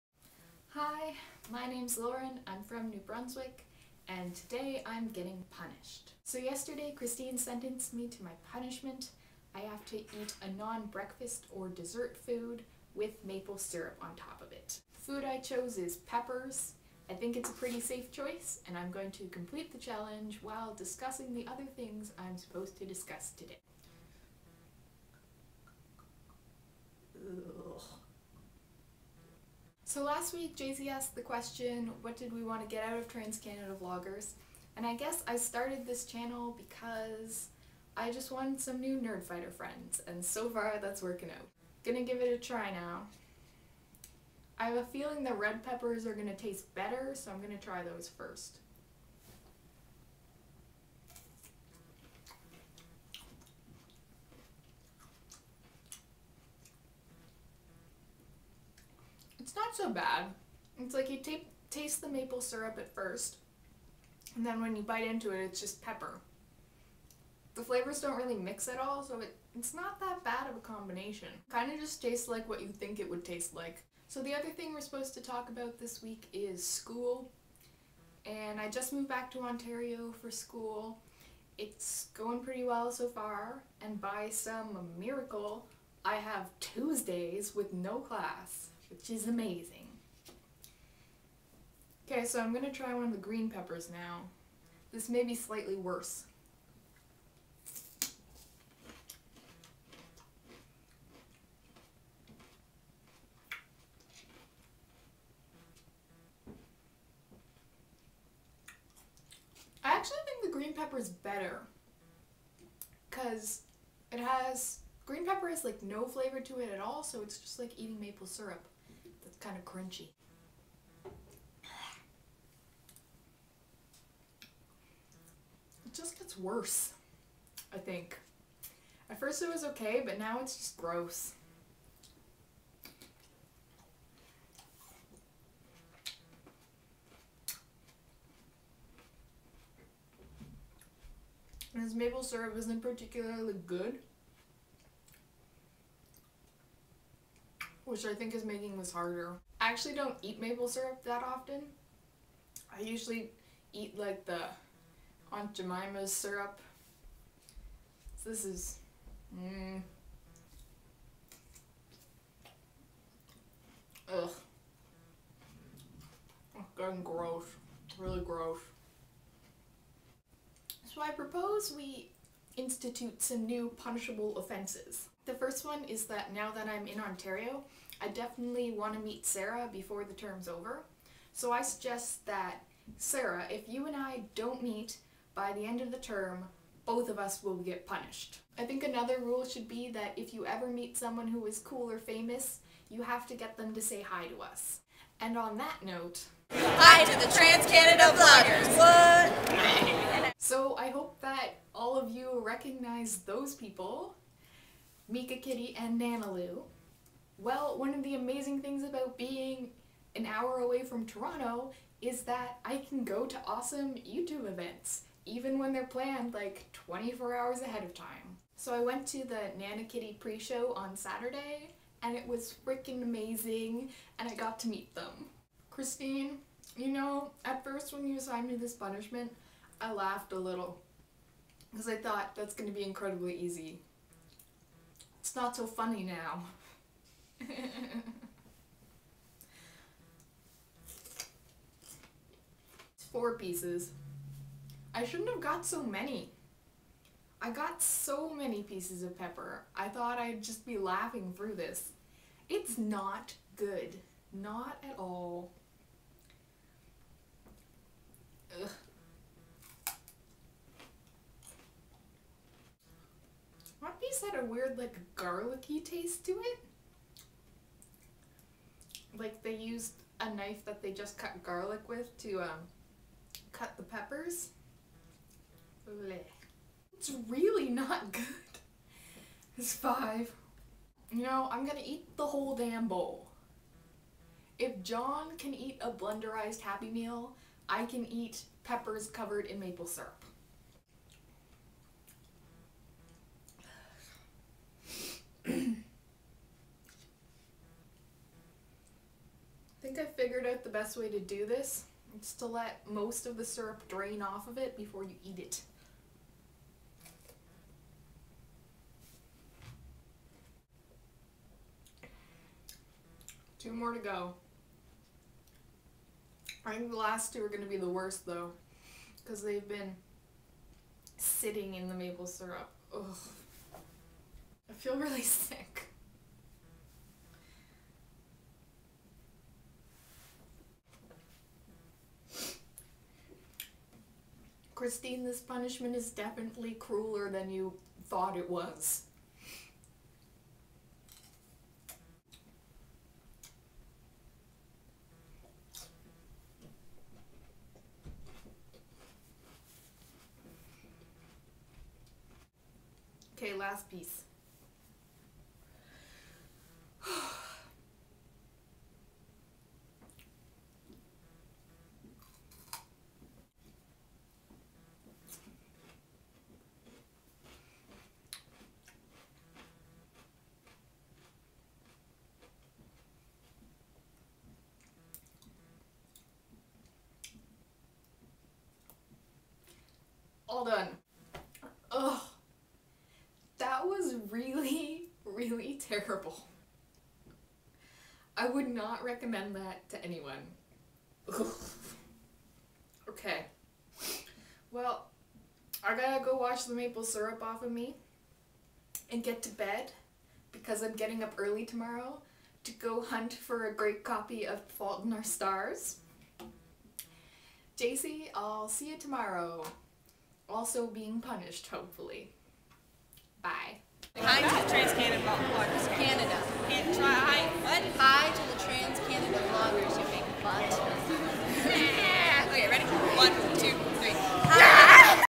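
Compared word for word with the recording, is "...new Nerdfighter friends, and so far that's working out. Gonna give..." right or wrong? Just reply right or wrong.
right.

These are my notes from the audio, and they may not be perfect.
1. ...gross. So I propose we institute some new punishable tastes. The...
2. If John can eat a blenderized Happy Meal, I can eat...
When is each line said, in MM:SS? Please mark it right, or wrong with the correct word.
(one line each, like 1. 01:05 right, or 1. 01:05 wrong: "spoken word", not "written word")
1. 02:48 wrong: "offenses", not "tastes"
2. 04:44 right.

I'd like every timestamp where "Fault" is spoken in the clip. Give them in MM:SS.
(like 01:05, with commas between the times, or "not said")
06:44.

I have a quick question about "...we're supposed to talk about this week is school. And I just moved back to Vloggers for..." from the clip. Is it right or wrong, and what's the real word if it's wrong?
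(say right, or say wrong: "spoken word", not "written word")
wrong: "Ontario", not "Vloggers".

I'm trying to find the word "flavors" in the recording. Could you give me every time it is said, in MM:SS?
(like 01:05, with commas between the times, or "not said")
01:07, 01:56.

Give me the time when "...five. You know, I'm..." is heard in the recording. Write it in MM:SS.
04:39.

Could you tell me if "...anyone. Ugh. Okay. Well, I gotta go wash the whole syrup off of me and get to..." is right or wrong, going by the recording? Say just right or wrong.
wrong.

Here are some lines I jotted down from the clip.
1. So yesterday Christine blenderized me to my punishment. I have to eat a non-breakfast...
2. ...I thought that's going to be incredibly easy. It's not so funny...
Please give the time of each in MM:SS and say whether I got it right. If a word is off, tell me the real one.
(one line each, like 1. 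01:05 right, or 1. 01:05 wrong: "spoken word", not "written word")
1. 00:06 wrong: "sentenced", not "blenderized"
2. 03:51 right.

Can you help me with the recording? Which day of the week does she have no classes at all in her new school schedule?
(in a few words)
Tuesdays.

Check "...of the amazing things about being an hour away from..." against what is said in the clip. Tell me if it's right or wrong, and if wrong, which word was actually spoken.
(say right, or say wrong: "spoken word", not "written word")
right.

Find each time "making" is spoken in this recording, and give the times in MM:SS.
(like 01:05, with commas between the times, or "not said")
02:28.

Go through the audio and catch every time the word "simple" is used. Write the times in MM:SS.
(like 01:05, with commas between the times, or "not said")
not said.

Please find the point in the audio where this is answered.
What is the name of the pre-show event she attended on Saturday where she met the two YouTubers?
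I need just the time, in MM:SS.
03:39.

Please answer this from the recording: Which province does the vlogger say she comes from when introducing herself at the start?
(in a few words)
New Brunswick.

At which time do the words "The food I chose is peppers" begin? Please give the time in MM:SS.
00:14.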